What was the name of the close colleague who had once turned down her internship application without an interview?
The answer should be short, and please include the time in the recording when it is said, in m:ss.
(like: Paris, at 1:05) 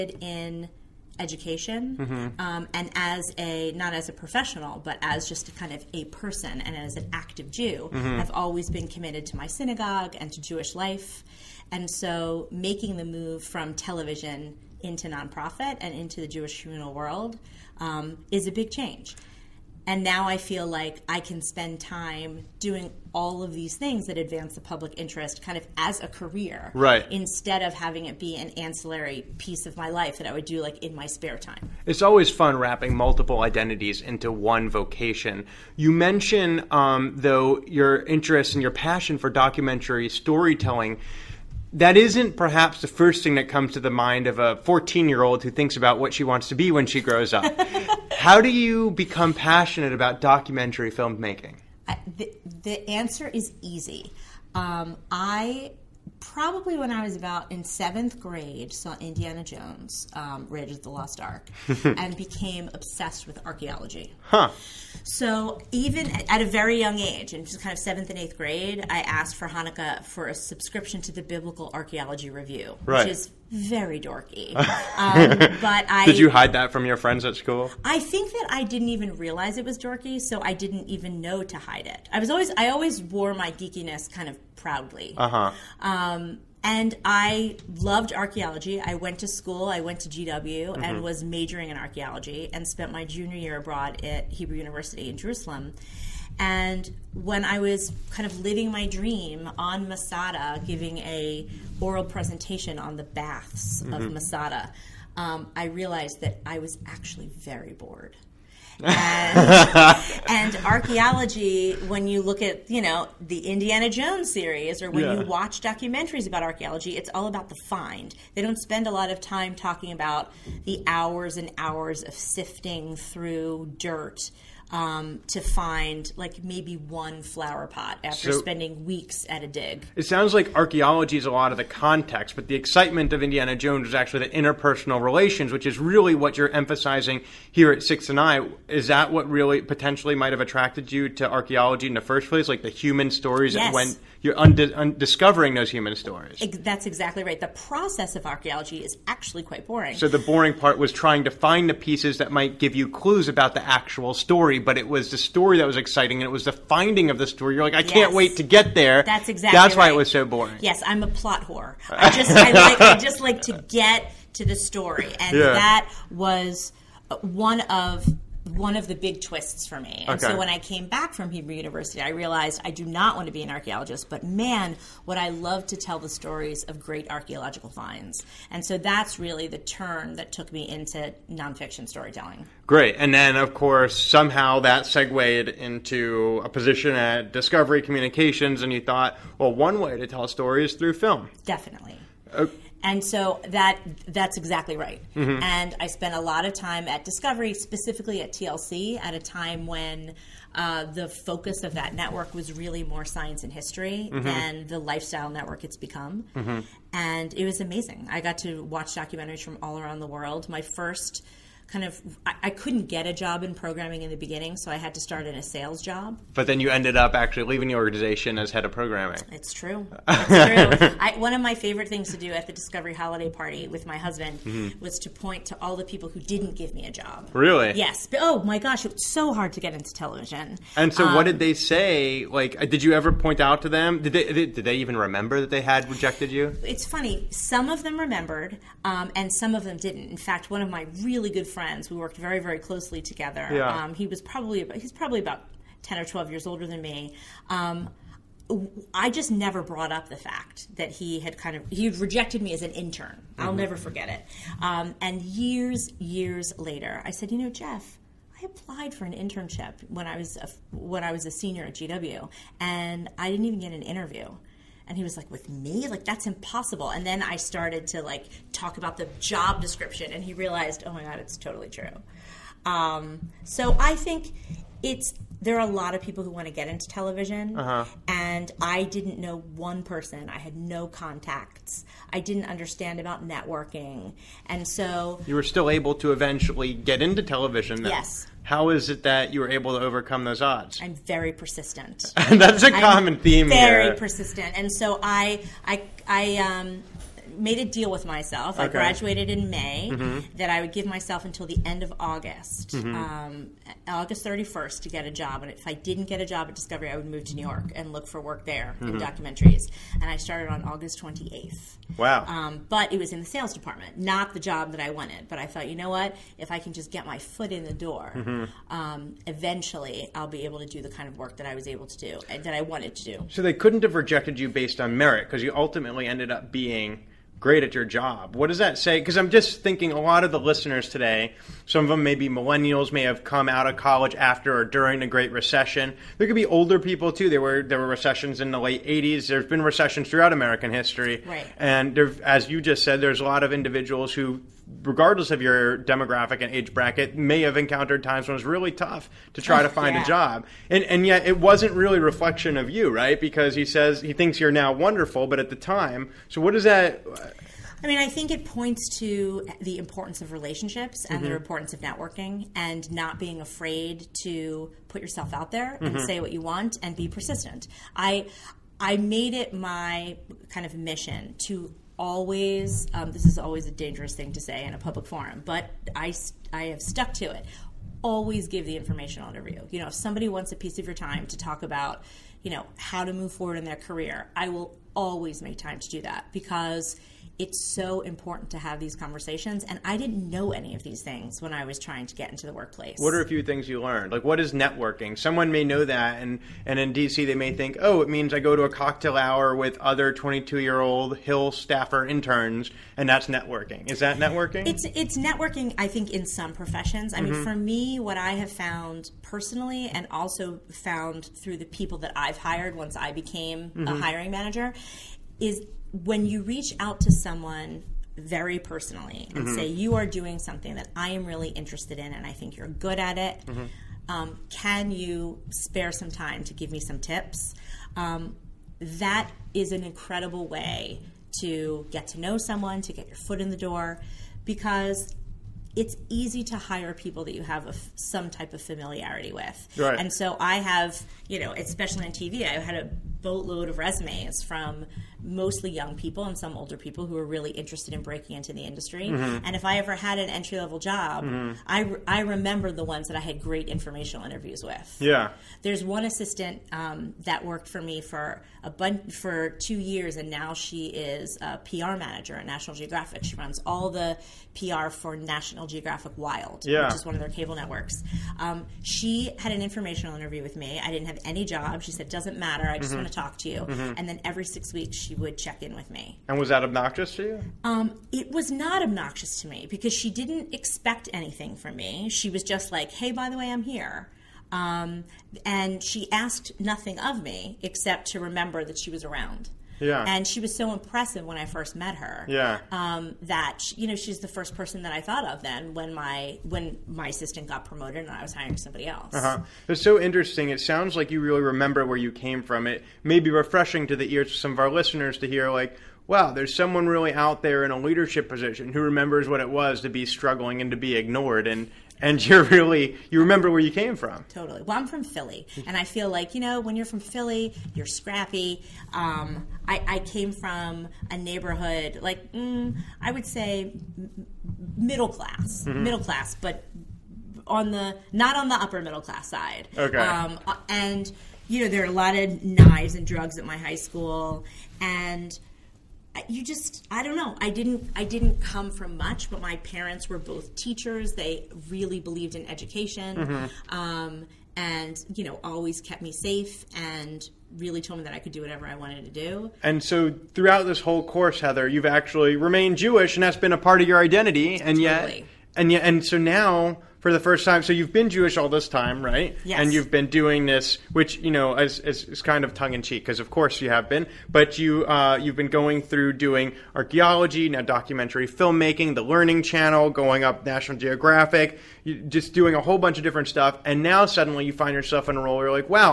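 Jeff, at 4:17.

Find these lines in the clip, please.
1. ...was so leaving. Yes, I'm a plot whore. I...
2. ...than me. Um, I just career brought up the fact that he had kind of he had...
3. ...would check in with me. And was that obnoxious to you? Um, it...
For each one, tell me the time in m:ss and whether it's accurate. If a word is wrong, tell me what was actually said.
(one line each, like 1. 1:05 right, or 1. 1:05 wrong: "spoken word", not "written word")
1. 2:39 wrong: "boring", not "leaving"
2. 4:06 wrong: "never", not "career"
3. 7:55 right.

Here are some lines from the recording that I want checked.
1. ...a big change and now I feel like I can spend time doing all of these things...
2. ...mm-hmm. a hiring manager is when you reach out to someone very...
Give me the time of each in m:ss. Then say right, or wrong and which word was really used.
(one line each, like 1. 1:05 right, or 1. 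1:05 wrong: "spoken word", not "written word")
1. 0:18 right
2. 6:53 right.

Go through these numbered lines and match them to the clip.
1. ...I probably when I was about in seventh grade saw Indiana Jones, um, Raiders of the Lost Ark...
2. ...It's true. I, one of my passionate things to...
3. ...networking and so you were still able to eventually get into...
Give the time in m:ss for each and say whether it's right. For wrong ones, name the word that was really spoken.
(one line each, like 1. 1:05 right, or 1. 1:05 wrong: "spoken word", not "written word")
1. 0:55 right
2. 3:40 wrong: "favorite", not "passionate"
3. 4:43 right.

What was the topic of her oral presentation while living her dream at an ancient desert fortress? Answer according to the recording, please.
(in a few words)
the baths.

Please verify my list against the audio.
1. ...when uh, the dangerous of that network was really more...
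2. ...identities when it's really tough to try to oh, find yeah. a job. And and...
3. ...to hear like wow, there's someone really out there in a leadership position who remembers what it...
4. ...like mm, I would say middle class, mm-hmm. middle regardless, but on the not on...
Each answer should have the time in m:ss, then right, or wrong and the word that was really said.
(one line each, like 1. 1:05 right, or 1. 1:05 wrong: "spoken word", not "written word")
1. 3:19 wrong: "focus", not "dangerous"
2. 5:48 wrong: "times", not "identities"
3. 8:25 right
4. 8:42 wrong: "class", not "regardless".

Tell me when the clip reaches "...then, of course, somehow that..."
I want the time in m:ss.
3:03.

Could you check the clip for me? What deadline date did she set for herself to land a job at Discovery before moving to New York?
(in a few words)
August 31.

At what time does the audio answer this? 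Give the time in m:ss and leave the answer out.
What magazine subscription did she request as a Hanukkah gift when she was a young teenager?
1:11.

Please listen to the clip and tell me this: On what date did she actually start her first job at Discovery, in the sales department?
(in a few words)
August 28.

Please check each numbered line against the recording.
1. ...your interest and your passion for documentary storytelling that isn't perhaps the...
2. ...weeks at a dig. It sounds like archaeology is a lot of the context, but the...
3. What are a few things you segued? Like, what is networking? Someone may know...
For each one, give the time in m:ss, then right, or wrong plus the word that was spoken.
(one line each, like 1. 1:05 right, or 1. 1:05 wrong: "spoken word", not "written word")
1. 0:37 right
2. 2:08 right
3. 6:32 wrong: "learned", not "segued".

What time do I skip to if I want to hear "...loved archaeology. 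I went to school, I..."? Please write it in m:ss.
1:27.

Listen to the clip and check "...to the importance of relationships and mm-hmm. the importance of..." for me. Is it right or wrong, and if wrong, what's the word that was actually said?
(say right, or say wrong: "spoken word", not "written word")
right.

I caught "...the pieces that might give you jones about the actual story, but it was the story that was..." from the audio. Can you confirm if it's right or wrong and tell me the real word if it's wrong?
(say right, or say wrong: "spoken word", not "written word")
wrong: "clues", not "jones".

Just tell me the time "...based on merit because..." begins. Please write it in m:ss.
5:24.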